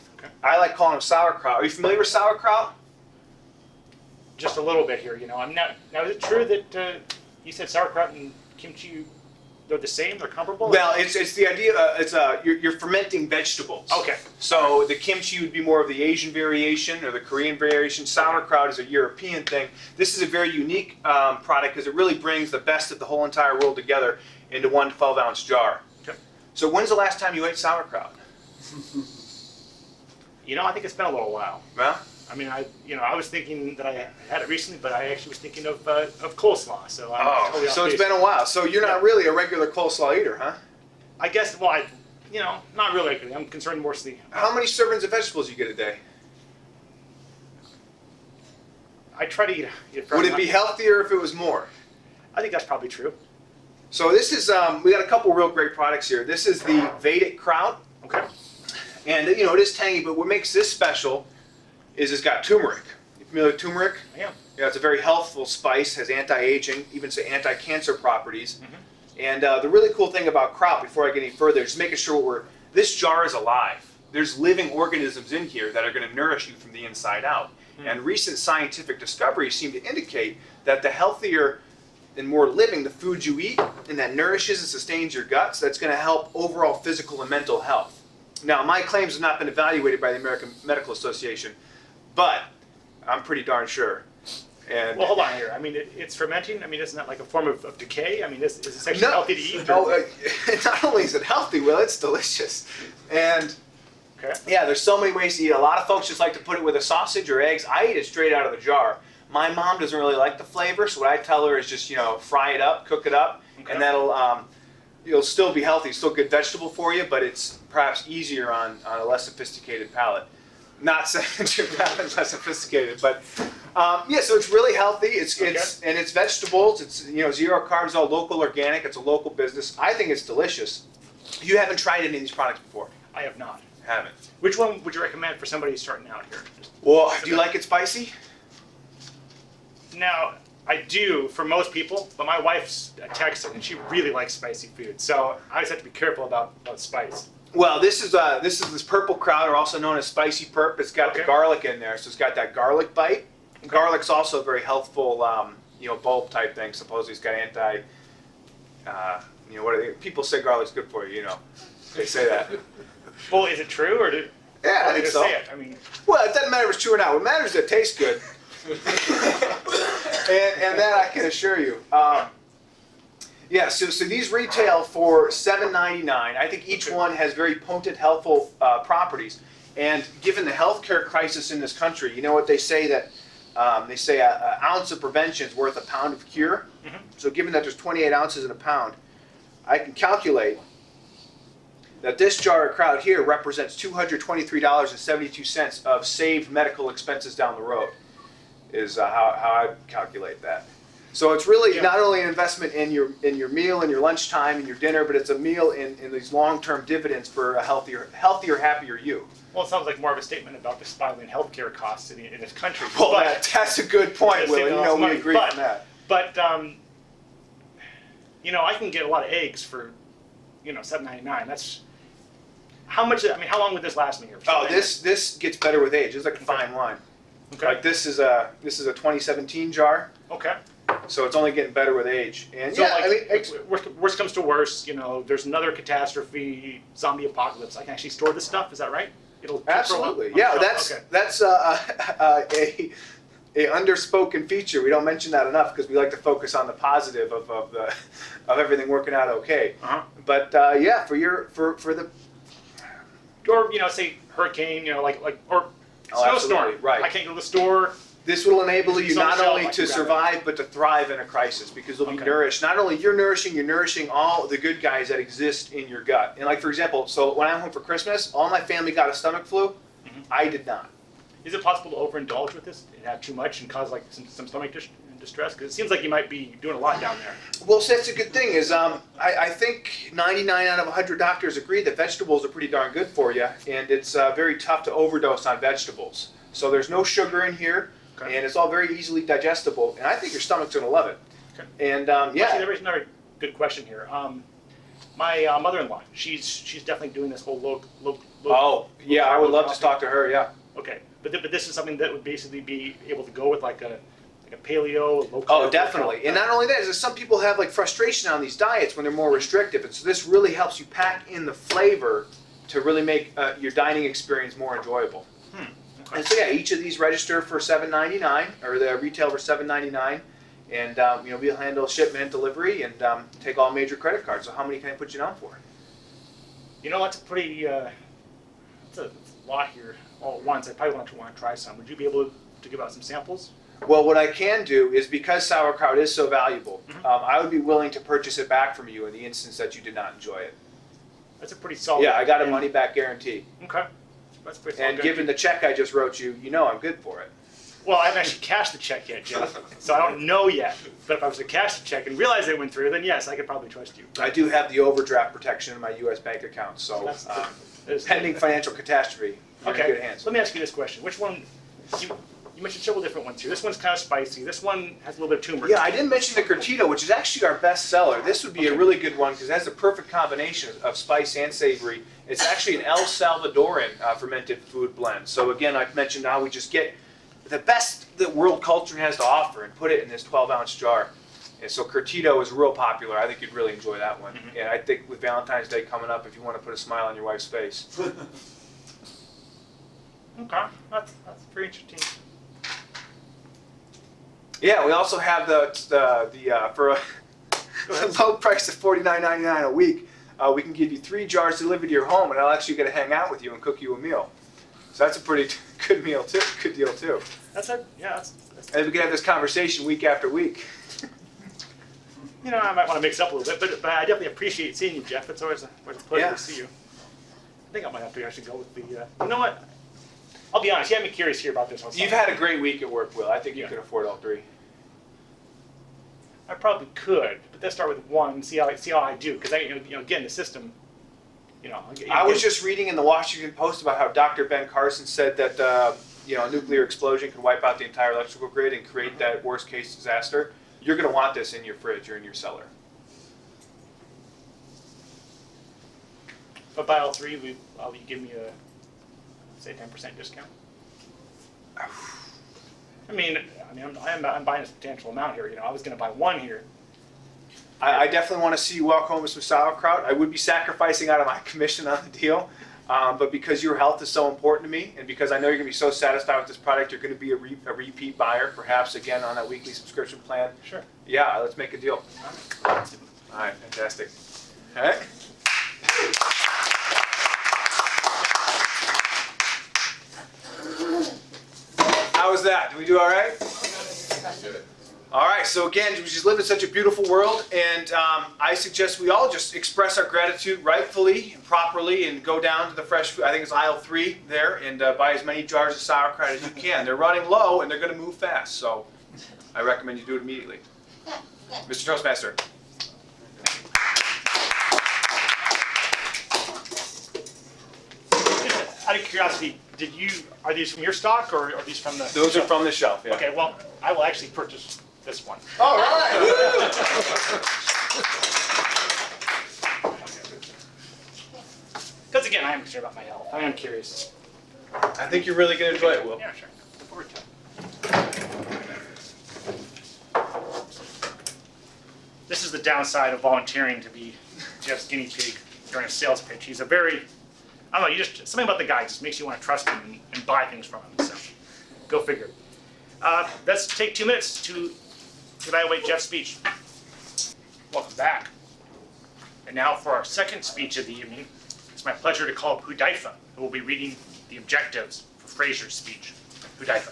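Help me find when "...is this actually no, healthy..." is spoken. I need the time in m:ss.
1:38.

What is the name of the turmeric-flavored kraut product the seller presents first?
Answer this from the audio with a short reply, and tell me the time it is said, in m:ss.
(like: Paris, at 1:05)
Vedic Kraut, at 0:56.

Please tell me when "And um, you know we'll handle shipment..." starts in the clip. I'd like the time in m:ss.
5:20.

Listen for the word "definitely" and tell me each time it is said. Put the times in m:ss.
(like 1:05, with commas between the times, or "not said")
4:56, 5:05, 6:54, 7:38.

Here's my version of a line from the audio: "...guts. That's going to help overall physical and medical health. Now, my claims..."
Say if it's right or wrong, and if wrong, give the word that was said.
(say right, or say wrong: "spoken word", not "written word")
wrong: "mental", not "medical".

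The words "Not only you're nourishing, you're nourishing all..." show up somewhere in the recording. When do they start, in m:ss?
4:22.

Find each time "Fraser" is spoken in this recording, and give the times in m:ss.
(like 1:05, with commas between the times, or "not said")
9:15.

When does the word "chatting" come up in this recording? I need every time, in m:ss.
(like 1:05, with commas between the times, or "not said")
not said.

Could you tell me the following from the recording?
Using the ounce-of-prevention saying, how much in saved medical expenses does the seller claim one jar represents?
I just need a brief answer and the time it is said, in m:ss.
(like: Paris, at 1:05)
$223.72, at 3:13.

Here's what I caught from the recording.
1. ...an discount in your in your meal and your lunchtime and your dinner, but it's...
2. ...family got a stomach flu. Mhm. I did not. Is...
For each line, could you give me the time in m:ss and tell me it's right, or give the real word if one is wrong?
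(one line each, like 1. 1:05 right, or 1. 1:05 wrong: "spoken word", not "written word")
1. 3:22 wrong: "investment", not "discount"
2. 4:28 right.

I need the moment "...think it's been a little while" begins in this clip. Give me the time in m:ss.
0:30.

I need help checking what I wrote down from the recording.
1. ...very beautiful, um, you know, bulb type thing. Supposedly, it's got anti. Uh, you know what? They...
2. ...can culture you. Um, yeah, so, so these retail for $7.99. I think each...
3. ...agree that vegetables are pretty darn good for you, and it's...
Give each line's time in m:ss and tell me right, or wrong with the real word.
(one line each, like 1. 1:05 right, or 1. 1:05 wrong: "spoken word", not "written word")
1. 2:34 wrong: "healthful", not "beautiful"
2. 2:51 wrong: "assure", not "culture"
3. 4:41 right.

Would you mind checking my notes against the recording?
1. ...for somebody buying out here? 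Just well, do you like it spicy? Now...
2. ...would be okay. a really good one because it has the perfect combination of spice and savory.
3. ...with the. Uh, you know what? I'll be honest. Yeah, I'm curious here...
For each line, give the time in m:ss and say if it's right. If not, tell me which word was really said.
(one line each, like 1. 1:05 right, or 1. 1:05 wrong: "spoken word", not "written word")
1. 2:15 wrong: "starting", not "buying"
2. 6:08 right
3. 6:58 right.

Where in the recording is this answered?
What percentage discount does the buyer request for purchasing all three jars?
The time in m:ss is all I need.
7:29.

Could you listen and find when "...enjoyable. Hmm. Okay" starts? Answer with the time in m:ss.
5:14.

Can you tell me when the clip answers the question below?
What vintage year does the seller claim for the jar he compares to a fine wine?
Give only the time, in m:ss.
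3:48.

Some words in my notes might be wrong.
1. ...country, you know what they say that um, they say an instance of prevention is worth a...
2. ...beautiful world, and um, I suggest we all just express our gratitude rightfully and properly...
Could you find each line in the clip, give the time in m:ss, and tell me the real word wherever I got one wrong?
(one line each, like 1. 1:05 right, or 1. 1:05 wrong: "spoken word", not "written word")
1. 3:01 wrong: "ounce", not "instance"
2. 8:06 right.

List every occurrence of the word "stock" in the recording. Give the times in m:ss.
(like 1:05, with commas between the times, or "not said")
8:30.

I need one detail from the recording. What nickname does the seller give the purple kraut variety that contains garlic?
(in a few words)
spicy perp.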